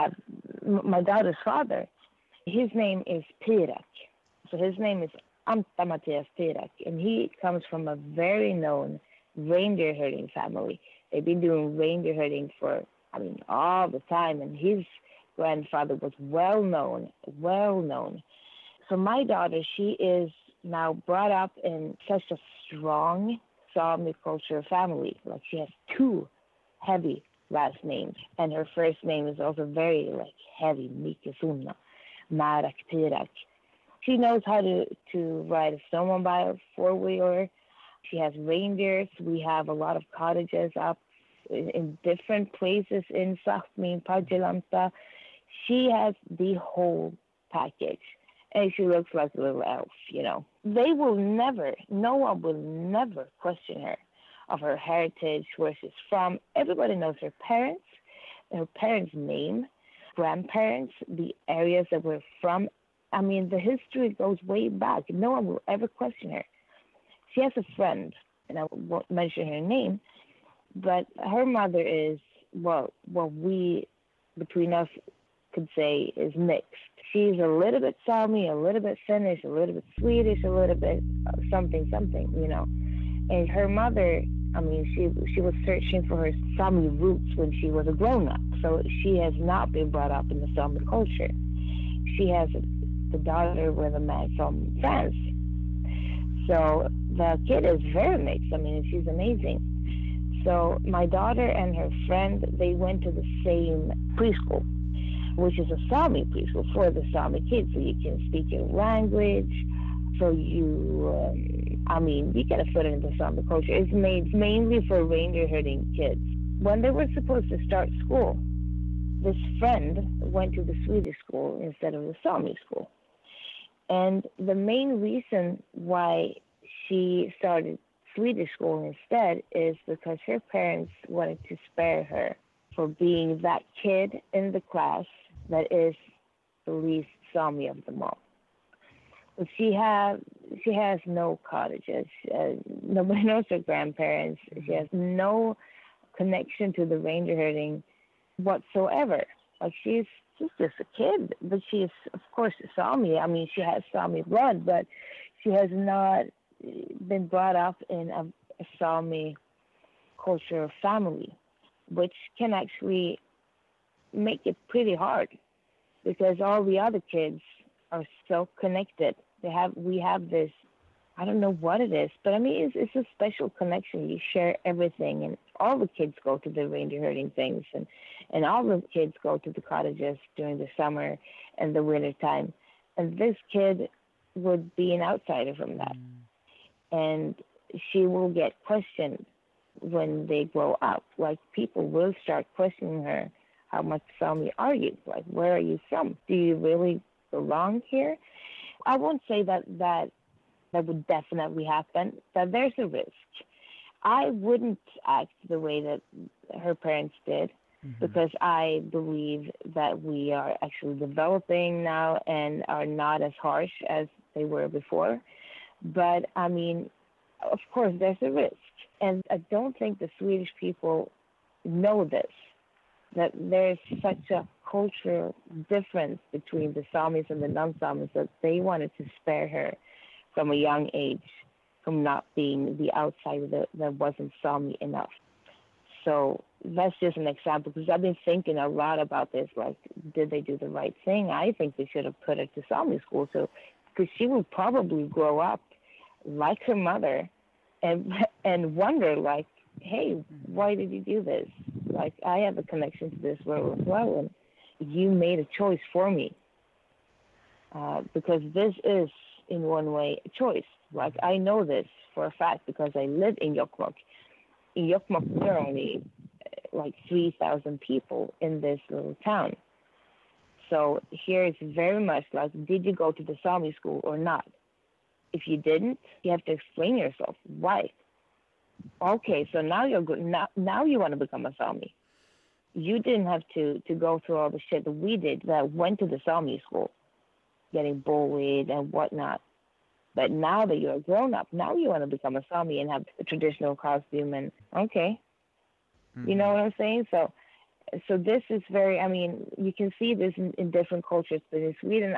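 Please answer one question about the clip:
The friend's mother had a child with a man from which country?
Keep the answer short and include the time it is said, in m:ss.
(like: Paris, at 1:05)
France, at 1:34.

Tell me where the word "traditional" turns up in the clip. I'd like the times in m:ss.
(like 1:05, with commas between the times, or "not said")
4:53.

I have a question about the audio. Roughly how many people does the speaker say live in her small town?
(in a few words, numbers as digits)
3,000.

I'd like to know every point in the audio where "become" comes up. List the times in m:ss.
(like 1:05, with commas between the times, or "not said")
4:41, 4:52.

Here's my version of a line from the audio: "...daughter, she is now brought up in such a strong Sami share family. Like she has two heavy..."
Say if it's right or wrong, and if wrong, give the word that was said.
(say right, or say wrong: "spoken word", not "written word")
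wrong: "culture", not "share".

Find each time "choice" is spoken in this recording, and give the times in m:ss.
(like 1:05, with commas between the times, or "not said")
4:15, 4:20.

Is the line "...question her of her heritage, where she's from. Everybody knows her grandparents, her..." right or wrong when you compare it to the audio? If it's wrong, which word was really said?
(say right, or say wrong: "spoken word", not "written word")
wrong: "parents", not "grandparents".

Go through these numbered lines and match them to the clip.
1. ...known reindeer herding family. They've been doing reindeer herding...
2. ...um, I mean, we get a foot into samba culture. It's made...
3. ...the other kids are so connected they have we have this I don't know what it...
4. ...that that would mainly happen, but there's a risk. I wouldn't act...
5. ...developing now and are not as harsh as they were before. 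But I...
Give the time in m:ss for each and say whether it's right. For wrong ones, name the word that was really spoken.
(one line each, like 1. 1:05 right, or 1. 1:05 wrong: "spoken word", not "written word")
1. 0:08 right
2. 1:51 right
3. 2:46 right
4. 3:19 wrong: "definitely", not "mainly"
5. 3:30 right.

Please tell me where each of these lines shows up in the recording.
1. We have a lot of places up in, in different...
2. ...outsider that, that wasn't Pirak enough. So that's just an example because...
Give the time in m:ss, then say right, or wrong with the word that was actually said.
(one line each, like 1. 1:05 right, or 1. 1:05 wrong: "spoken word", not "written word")
1. 0:39 wrong: "cottages", not "places"
2. 3:52 wrong: "Sami", not "Pirak".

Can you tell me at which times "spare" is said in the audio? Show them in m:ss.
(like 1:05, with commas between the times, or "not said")
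2:11, 3:49.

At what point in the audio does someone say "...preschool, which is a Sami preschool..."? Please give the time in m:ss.
1:44.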